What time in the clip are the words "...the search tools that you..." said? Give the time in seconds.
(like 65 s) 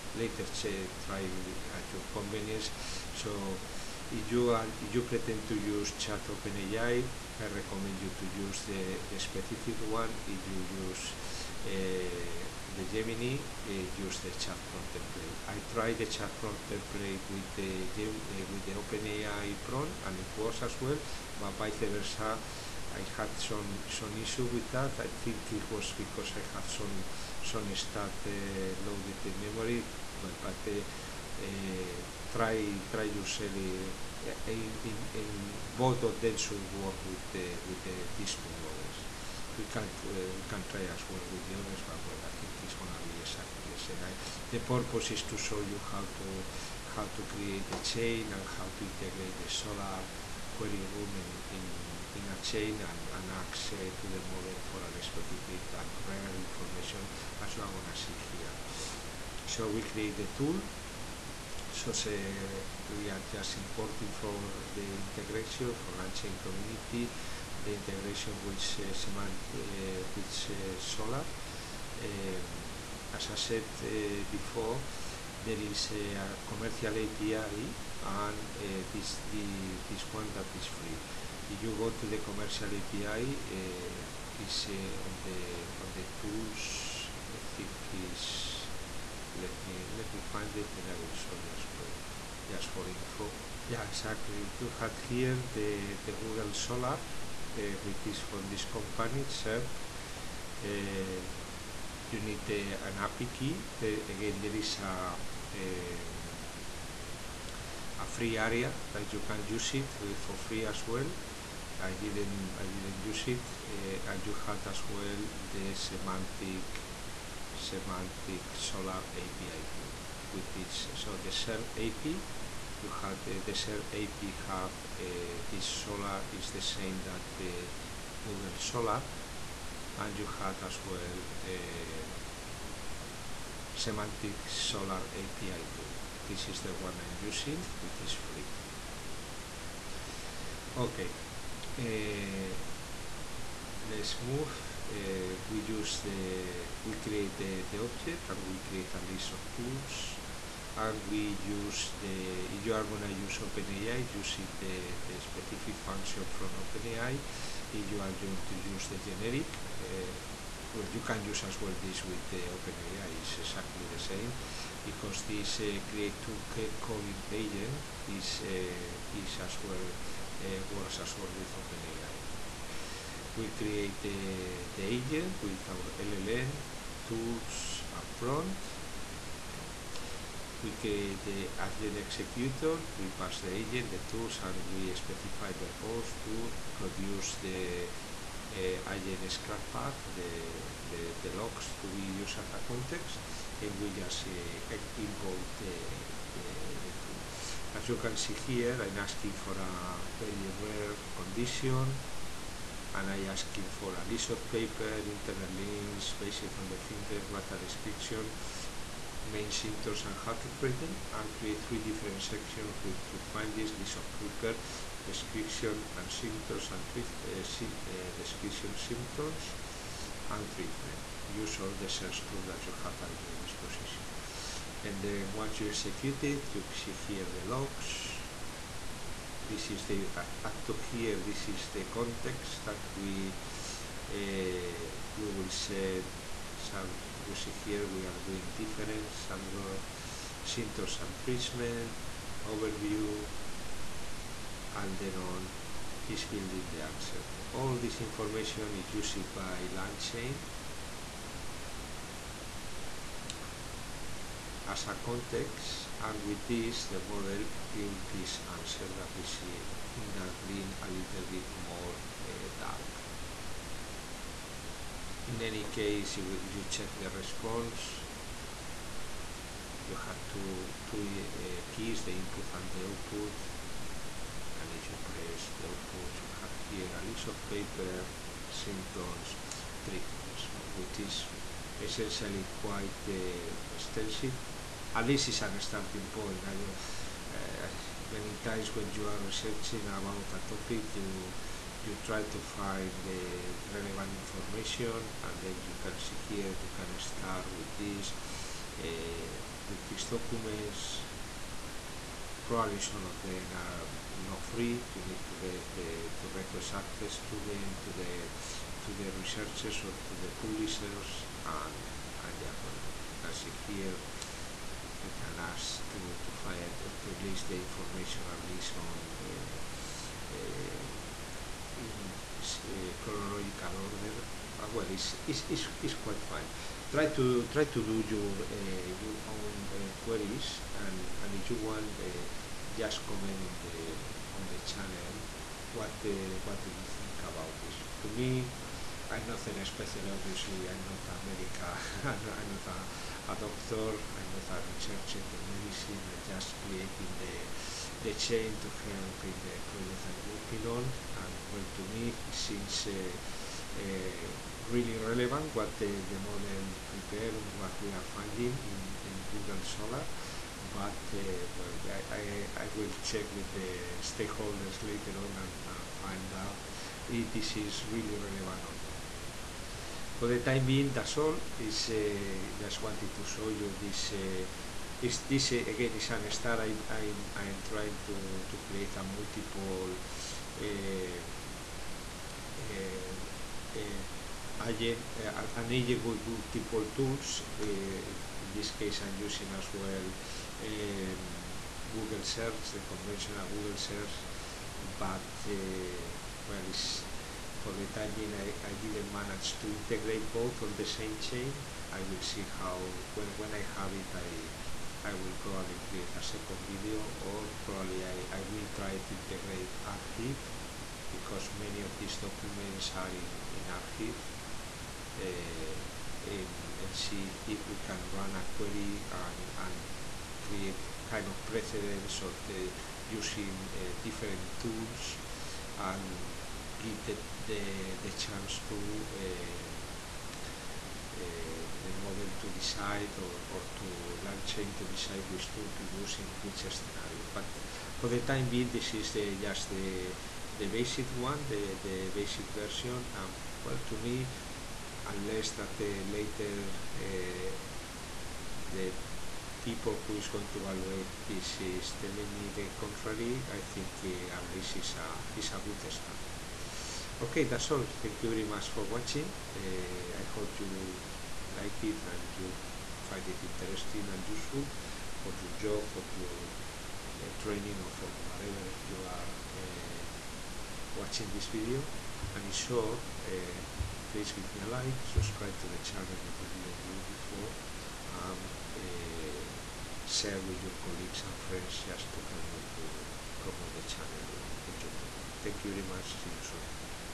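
221 s.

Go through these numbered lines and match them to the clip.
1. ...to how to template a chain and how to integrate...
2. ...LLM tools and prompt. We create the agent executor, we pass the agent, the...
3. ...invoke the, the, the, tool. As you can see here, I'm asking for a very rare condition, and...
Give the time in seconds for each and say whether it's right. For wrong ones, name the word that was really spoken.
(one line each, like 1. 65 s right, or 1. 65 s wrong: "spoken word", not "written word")
1. 46 s wrong: "create", not "template"
2. 175 s right
3. 194 s right.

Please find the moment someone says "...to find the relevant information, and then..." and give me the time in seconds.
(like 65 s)
292 s.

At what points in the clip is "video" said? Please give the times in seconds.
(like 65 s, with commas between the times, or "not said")
406 s, 471 s.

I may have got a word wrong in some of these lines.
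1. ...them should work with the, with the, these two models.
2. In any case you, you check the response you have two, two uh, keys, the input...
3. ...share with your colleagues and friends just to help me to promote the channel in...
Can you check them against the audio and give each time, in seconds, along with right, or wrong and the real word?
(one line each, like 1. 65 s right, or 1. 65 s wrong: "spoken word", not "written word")
1. 36 s right
2. 265 s right
3. 480 s right.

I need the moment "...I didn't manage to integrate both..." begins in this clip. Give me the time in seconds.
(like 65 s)
398 s.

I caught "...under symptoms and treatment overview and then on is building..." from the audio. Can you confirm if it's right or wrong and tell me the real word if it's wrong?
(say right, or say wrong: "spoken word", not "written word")
right.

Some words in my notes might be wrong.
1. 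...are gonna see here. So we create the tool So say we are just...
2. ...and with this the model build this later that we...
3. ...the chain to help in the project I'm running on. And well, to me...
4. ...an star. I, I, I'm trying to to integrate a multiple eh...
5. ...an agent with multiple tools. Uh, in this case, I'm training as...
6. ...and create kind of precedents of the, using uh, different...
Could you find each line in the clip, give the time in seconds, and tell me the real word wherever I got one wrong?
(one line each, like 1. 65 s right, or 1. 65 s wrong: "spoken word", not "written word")
1. 57 s right
2. 256 s wrong: "answer", not "later"
3. 348 s wrong: "working", not "running"
4. 376 s wrong: "create", not "integrate"
5. 385 s wrong: "using", not "training"
6. 419 s right.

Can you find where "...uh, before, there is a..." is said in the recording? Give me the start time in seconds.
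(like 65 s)
73 s.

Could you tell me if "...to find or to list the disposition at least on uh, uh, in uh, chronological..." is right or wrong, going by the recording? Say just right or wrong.
wrong.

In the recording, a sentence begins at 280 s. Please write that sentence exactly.
which is essentially quite uh, extensive at least it's a starting point.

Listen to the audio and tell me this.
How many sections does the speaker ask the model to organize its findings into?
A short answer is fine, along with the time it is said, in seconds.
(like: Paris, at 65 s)
3, at 211 s.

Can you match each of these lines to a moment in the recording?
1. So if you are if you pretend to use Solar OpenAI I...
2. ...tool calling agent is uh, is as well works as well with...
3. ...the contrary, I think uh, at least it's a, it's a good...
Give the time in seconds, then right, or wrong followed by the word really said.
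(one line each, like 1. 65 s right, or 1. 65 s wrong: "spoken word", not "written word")
1. 3 s wrong: "Chat", not "Solar"
2. 166 s right
3. 452 s right.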